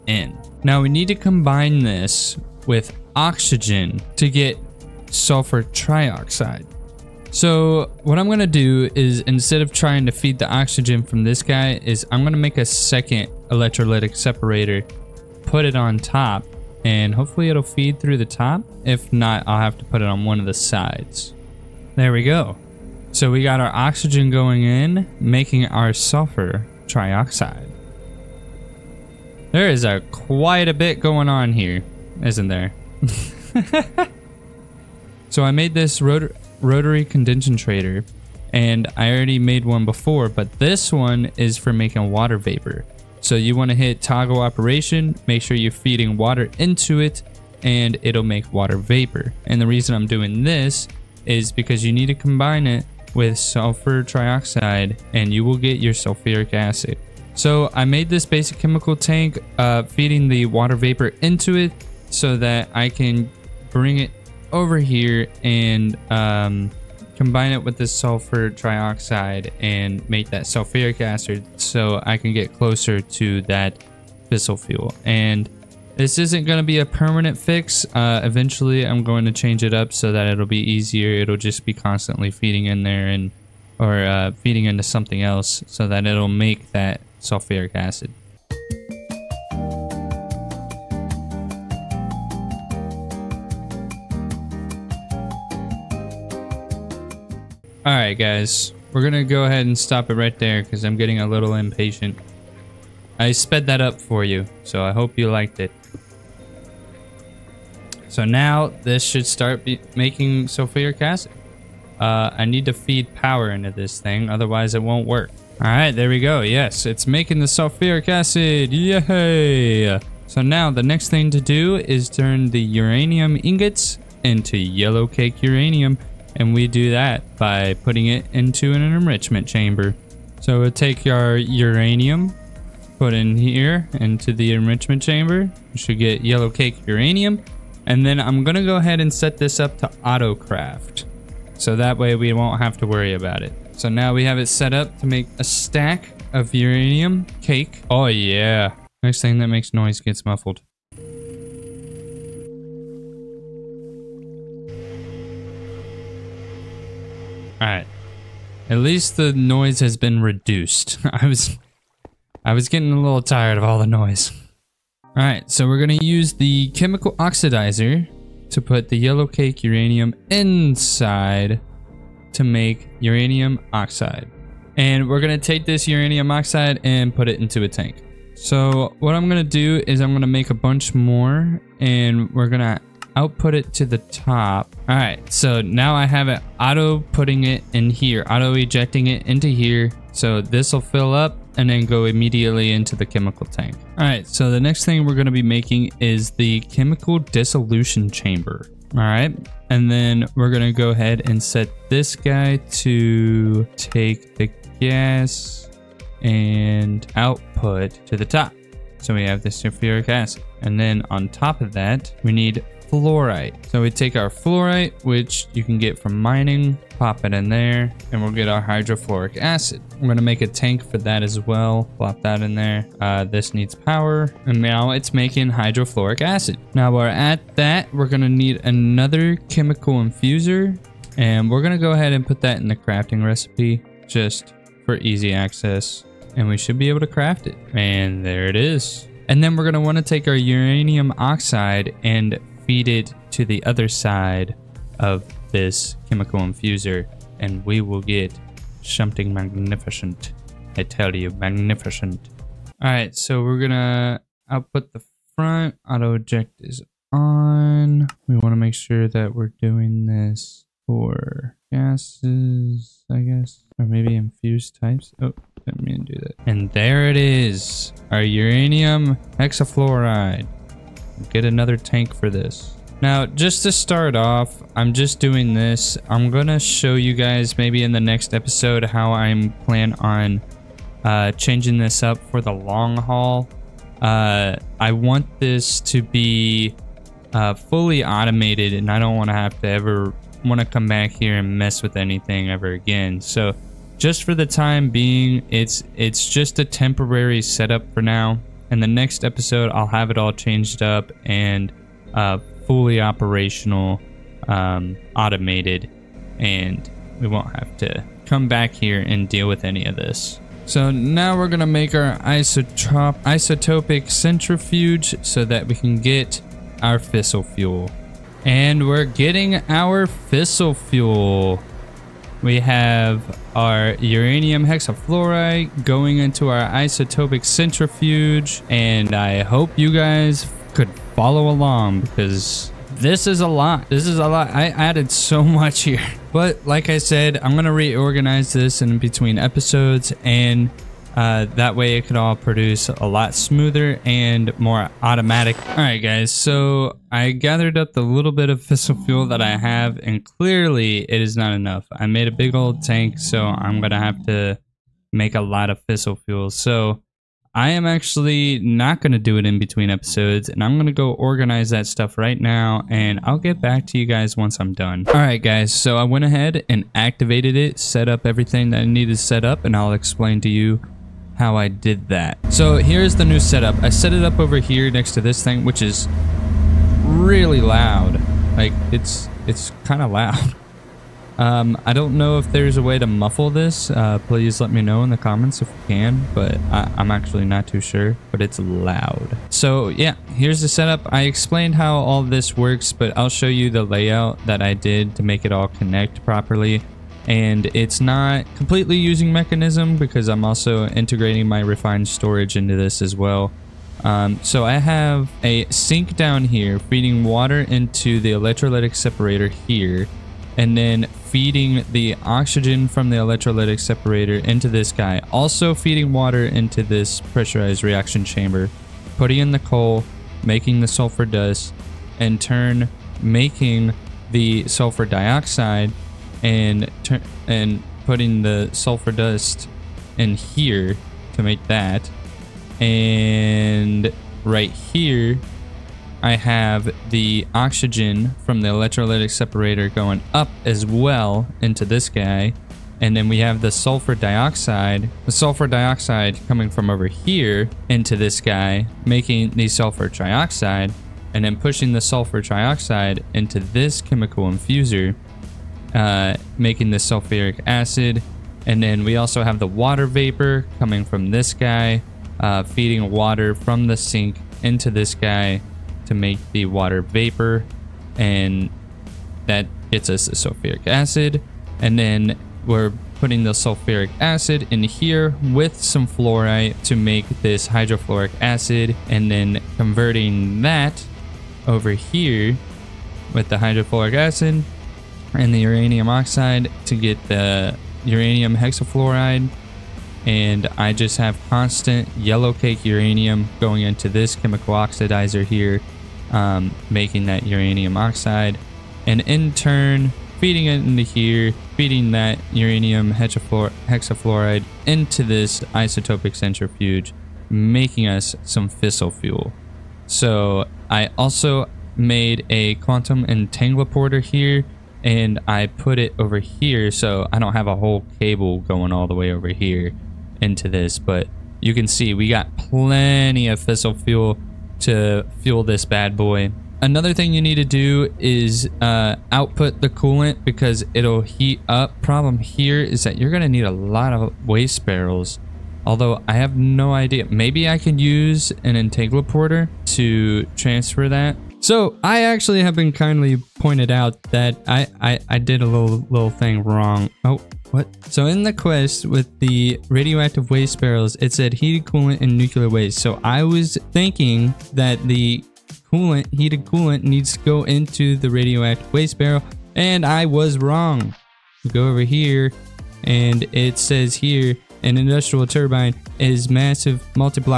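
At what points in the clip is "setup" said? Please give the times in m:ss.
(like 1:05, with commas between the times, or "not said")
4:57, 6:13, 6:30.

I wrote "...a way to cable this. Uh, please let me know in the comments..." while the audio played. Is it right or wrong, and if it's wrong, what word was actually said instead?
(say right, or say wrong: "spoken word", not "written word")
wrong: "muffle", not "cable".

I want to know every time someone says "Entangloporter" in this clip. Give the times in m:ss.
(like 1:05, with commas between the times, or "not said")
8:33, 8:58.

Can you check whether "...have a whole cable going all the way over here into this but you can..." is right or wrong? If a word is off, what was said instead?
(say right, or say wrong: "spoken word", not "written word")
right.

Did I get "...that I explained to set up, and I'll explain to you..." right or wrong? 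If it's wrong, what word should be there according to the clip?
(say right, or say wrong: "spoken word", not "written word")
wrong: "needed", not "explained".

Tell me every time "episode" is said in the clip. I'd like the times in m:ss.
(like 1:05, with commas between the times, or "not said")
4:38, 4:59, 5:39, 5:59.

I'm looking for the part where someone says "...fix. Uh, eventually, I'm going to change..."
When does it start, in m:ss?
1:17.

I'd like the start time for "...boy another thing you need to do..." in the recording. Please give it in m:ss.
8:46.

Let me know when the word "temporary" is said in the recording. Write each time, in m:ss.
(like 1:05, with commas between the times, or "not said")
4:56.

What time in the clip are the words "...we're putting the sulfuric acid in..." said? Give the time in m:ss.
7:52.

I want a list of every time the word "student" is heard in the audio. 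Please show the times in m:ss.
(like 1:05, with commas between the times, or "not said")
not said.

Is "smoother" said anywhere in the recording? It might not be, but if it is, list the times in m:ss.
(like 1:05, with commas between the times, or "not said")
5:43.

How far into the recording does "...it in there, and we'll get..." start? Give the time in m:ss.
3:37.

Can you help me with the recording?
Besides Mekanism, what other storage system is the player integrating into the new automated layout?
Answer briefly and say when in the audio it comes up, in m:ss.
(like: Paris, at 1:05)
refined storage, at 6:41.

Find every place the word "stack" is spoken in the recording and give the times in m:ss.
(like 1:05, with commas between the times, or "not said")
2:25.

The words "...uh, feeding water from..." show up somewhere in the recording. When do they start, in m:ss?
7:42.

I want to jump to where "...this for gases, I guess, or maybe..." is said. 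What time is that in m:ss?
4:20.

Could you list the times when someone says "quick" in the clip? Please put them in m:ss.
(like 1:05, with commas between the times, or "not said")
not said.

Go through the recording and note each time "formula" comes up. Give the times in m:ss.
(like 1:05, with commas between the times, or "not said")
not said.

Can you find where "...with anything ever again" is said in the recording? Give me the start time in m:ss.
4:51.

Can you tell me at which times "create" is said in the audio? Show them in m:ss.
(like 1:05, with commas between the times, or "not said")
not said.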